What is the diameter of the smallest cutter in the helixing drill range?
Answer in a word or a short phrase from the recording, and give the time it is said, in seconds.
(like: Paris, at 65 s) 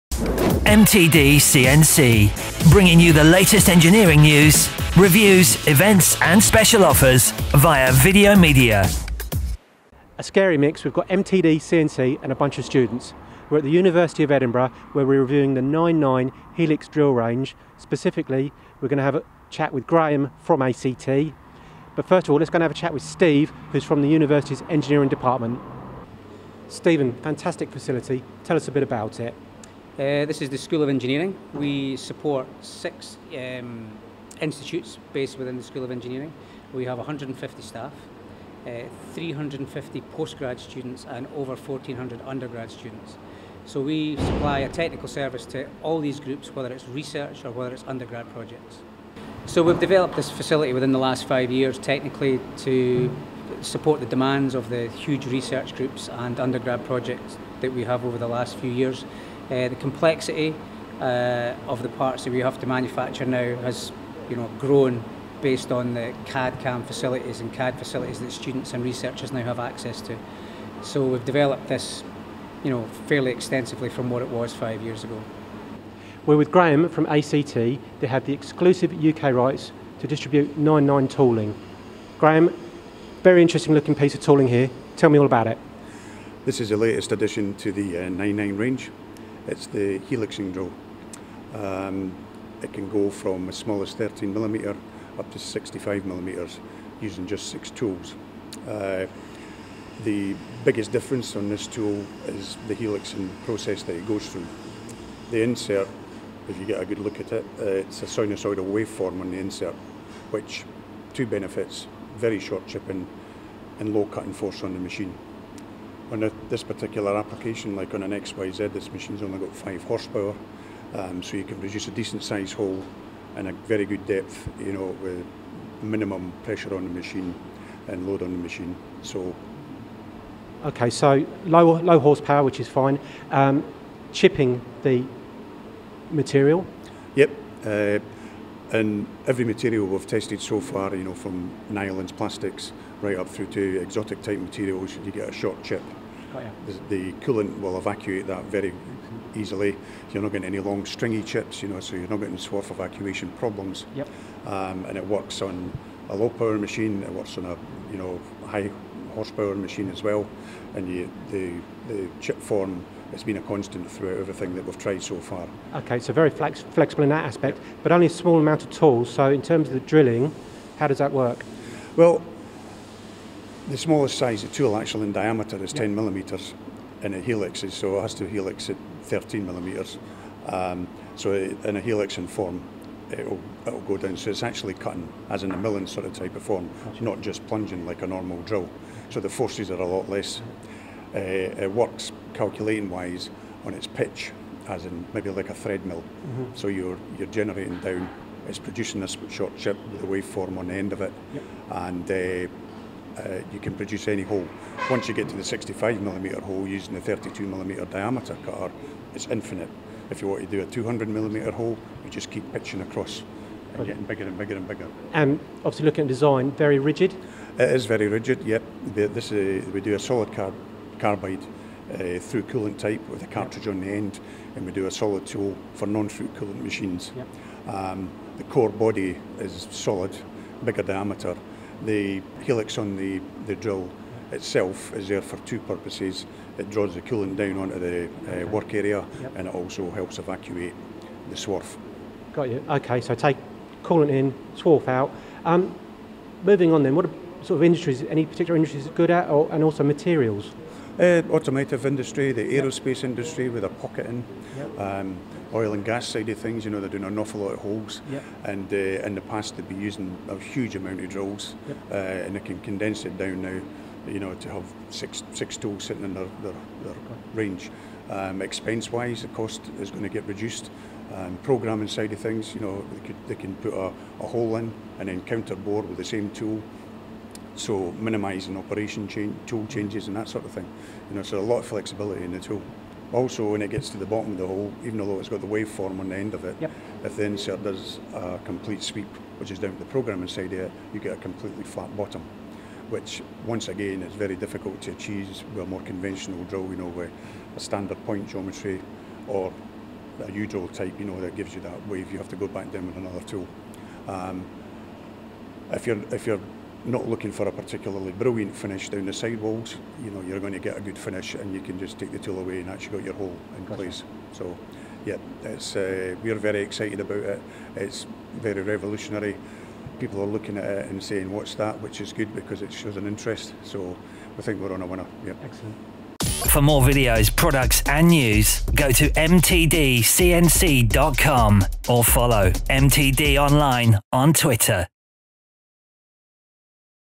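10 millimetres, at 175 s.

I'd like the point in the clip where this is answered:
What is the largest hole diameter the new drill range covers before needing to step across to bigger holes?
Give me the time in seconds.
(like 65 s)
95 s.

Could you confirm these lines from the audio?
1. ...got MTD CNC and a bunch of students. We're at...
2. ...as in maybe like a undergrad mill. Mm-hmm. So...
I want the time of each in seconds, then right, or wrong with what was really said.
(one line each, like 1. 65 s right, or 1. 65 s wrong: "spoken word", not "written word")
1. 10 s right
2. 194 s wrong: "thread", not "undergrad".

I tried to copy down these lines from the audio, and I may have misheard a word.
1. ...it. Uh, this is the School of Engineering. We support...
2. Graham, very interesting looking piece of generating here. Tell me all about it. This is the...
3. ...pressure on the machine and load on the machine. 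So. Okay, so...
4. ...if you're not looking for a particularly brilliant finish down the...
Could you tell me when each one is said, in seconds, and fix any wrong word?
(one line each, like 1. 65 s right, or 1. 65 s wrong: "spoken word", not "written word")
1. 29 s right
2. 82 s wrong: "tooling", not "generating"
3. 126 s right
4. 306 s right.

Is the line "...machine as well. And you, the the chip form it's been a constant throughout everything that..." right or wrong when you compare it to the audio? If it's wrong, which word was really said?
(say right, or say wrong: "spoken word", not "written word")
right.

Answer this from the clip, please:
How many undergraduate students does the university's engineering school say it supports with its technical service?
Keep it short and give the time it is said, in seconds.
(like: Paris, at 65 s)
1,400, at 41 s.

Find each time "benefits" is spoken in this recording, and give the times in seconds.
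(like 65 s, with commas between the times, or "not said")
111 s.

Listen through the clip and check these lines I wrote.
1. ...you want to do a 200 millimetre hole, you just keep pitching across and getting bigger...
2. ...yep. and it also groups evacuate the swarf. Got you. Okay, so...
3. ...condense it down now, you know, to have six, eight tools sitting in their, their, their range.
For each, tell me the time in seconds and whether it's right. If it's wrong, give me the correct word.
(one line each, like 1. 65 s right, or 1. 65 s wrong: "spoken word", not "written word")
1. 210 s right
2. 239 s wrong: "helps", not "groups"
3. 262 s wrong: "six", not "eight".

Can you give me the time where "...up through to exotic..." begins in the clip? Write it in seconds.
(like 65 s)
143 s.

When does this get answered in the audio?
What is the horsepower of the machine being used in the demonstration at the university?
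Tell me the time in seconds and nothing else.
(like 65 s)
119 s.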